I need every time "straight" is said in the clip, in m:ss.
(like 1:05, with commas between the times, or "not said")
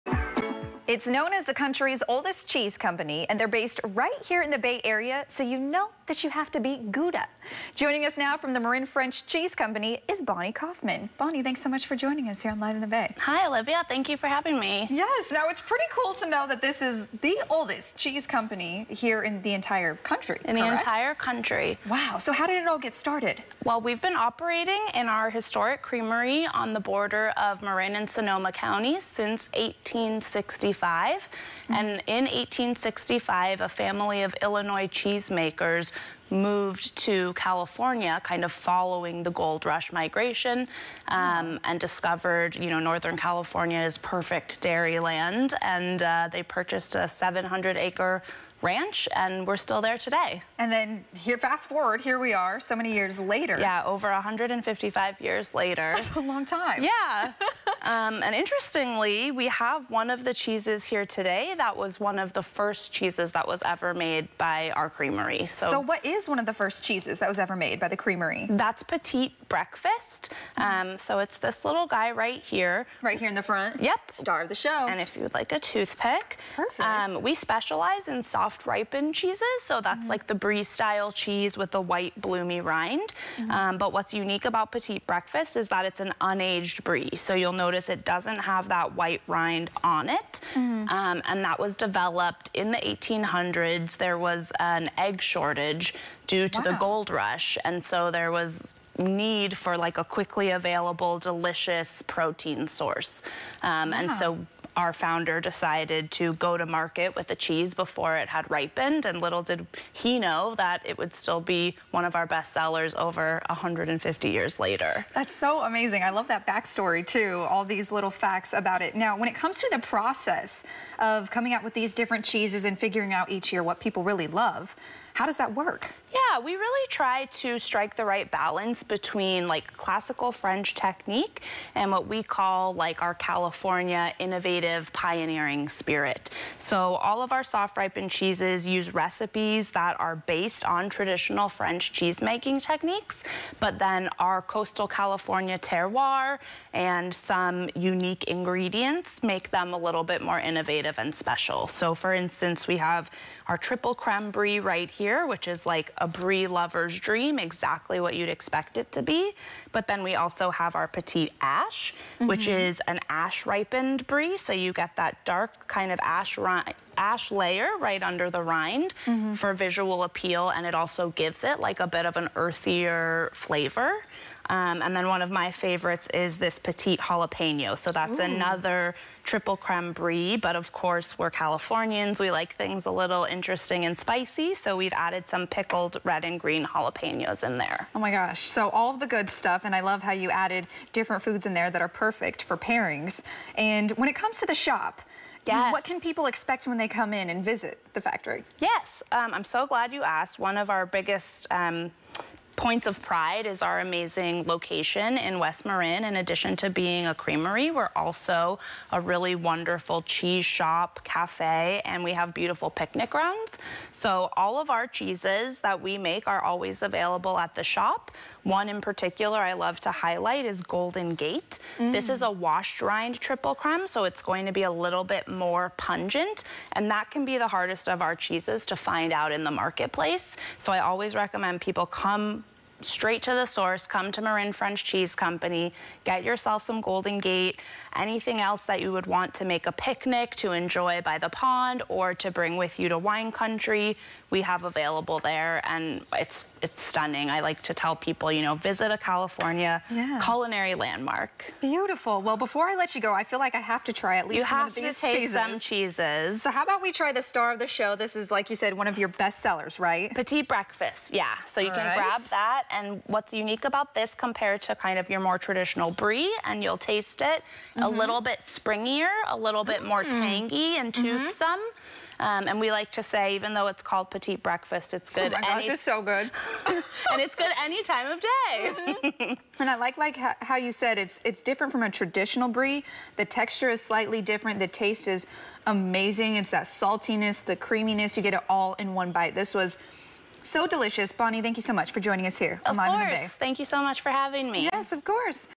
3:52.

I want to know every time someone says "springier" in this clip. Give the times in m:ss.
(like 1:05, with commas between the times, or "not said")
4:28.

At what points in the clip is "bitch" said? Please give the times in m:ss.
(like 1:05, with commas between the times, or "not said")
not said.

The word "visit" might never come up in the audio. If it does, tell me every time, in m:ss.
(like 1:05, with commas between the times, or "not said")
3:17, 4:08.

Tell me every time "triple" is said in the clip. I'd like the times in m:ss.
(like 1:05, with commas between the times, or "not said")
2:33, 2:59, 3:43.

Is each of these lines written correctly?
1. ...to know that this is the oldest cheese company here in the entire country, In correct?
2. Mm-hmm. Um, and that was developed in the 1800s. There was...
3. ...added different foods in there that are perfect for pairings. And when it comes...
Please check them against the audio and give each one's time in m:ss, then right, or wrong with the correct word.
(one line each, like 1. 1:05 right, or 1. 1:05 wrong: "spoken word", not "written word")
1. 0:16 right
2. 1:30 right
3. 3:10 right.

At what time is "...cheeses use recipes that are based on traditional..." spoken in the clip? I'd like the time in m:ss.
2:18.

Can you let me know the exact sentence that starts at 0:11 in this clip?
Bonnie, thanks so much for joining us here on Live in the Bay.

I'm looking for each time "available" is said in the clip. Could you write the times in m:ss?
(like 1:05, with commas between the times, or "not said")
1:40, 3:36, 4:04.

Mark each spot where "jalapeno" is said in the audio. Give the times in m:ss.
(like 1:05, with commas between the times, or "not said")
2:56, 3:06.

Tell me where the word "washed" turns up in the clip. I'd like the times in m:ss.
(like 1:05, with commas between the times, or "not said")
3:42.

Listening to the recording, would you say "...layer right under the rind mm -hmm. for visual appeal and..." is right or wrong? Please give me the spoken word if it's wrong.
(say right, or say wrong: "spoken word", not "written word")
right.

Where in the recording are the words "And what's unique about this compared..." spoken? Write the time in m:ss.
4:22.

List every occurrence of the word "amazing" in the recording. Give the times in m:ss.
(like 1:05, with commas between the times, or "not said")
1:55, 3:23, 4:45.